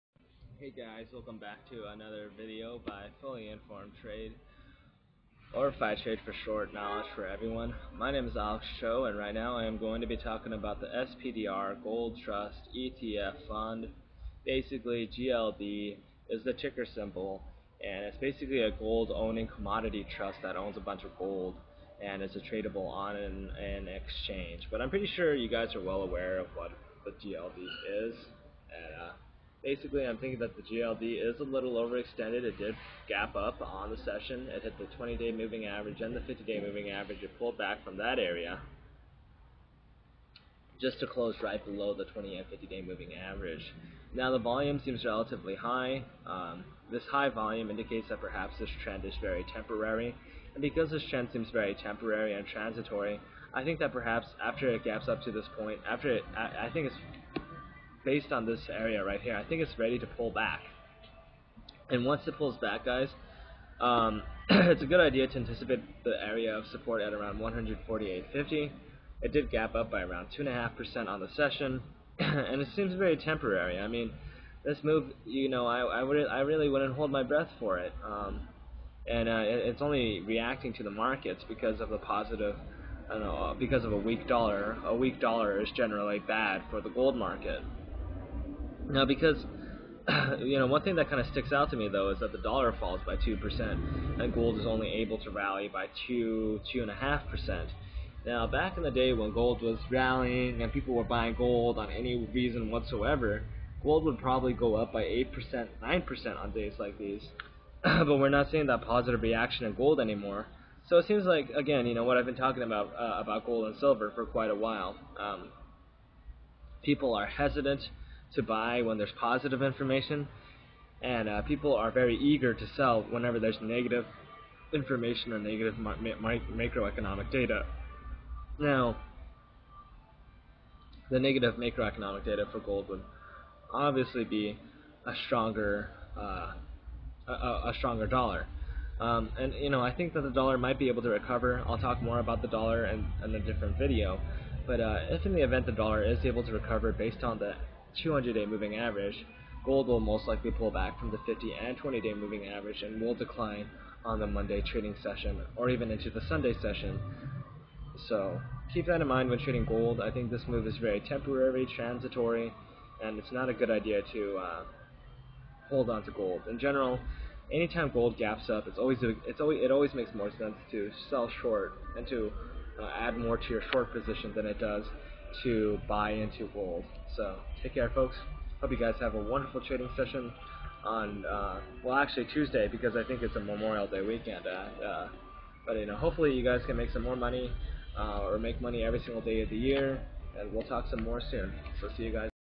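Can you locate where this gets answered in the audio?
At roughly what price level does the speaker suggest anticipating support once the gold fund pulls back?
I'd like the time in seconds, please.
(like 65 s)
67 s.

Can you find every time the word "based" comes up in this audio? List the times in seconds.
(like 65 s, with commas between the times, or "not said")
58 s, 146 s.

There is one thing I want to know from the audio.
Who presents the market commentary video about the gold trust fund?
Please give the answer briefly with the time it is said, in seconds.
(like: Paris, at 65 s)
Alex Cho, at 8 s.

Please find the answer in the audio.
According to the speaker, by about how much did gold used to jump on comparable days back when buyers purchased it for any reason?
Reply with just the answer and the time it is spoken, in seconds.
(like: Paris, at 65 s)
8%, 9%, at 105 s.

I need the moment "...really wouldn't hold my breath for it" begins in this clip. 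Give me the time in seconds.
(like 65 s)
76 s.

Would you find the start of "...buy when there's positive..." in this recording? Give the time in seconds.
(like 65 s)
118 s.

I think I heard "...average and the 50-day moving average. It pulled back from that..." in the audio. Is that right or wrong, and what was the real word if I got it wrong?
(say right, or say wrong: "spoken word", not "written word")
right.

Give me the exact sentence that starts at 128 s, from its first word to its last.
Now, the negative macroeconomic data for gold would obviously be a stronger uh, a, a, stronger dollar.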